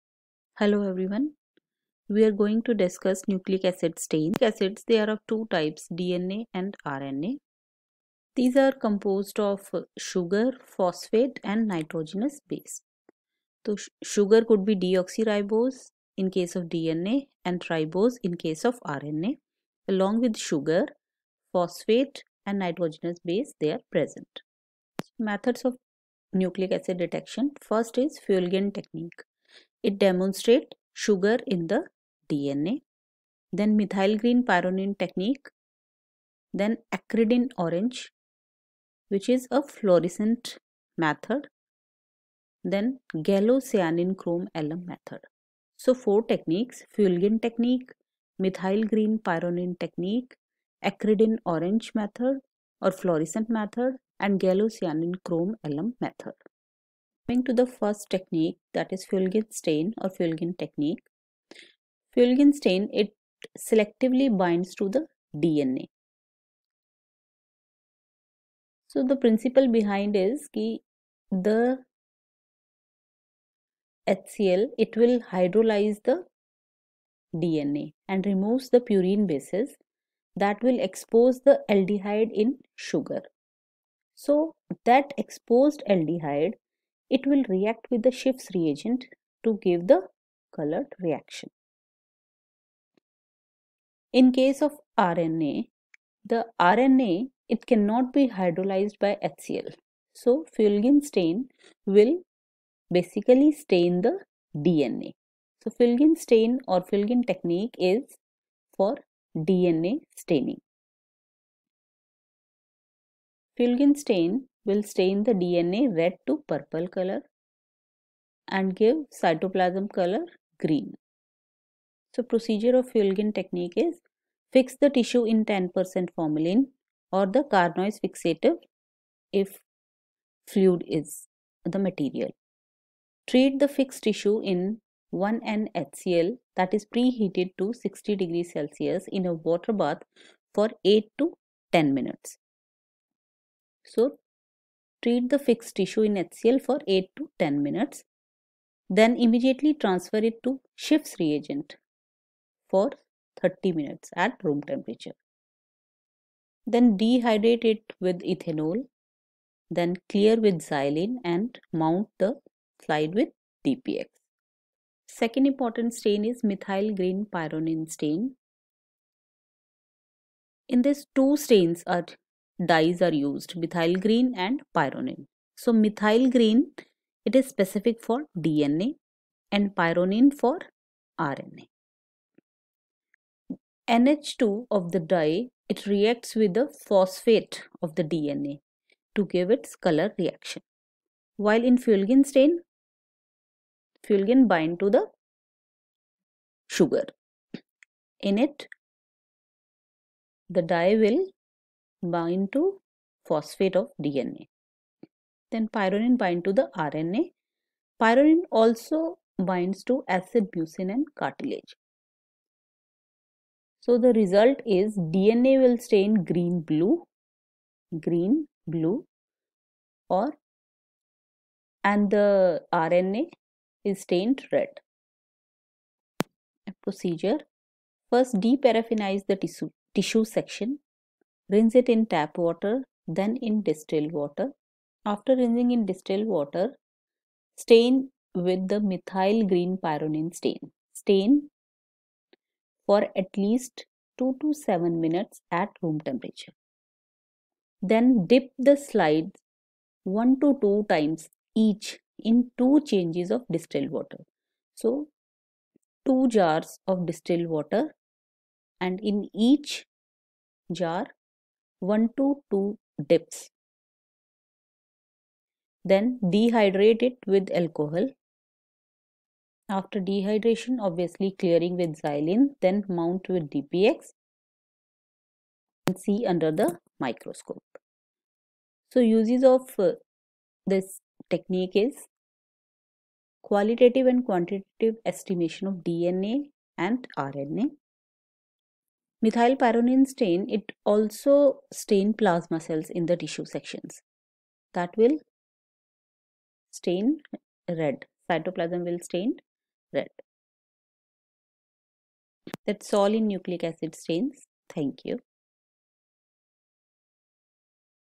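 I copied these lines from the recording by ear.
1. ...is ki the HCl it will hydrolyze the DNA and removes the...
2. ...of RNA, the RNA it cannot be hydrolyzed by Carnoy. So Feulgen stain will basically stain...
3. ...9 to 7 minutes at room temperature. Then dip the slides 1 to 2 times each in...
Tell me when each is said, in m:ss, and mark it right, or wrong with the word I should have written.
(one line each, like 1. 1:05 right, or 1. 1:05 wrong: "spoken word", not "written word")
1. 1:10 right
2. 1:34 wrong: "HCl", not "Carnoy"
3. 4:04 wrong: "2", not "9".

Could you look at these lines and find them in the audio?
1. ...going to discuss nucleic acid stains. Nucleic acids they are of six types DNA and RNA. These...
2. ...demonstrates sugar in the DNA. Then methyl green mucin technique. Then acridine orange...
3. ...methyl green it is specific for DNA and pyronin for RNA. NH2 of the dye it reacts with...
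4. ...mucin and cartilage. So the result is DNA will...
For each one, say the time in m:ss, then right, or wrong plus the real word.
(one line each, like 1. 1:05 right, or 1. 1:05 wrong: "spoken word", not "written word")
1. 0:02 wrong: "two", not "six"
2. 0:29 wrong: "pyronin", not "mucin"
3. 2:55 right
4. 3:30 right.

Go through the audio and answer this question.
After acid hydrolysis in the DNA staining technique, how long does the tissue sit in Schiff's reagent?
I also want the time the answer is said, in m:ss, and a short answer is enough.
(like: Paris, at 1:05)
30 minutes, at 2:33.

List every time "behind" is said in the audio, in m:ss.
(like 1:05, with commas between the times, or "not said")
1:09.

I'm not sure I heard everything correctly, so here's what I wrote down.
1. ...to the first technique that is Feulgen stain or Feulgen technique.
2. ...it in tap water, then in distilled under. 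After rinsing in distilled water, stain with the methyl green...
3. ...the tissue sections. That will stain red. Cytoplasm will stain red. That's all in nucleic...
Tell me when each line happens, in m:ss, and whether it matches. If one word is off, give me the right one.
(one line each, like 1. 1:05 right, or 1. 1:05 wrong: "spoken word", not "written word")
1. 0:57 right
2. 3:51 wrong: "water", not "under"
3. 4:53 right.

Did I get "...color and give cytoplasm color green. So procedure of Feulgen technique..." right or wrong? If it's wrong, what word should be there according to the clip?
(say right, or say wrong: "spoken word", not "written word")
right.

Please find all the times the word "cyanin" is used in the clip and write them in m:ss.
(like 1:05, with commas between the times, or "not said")
0:43, 0:54.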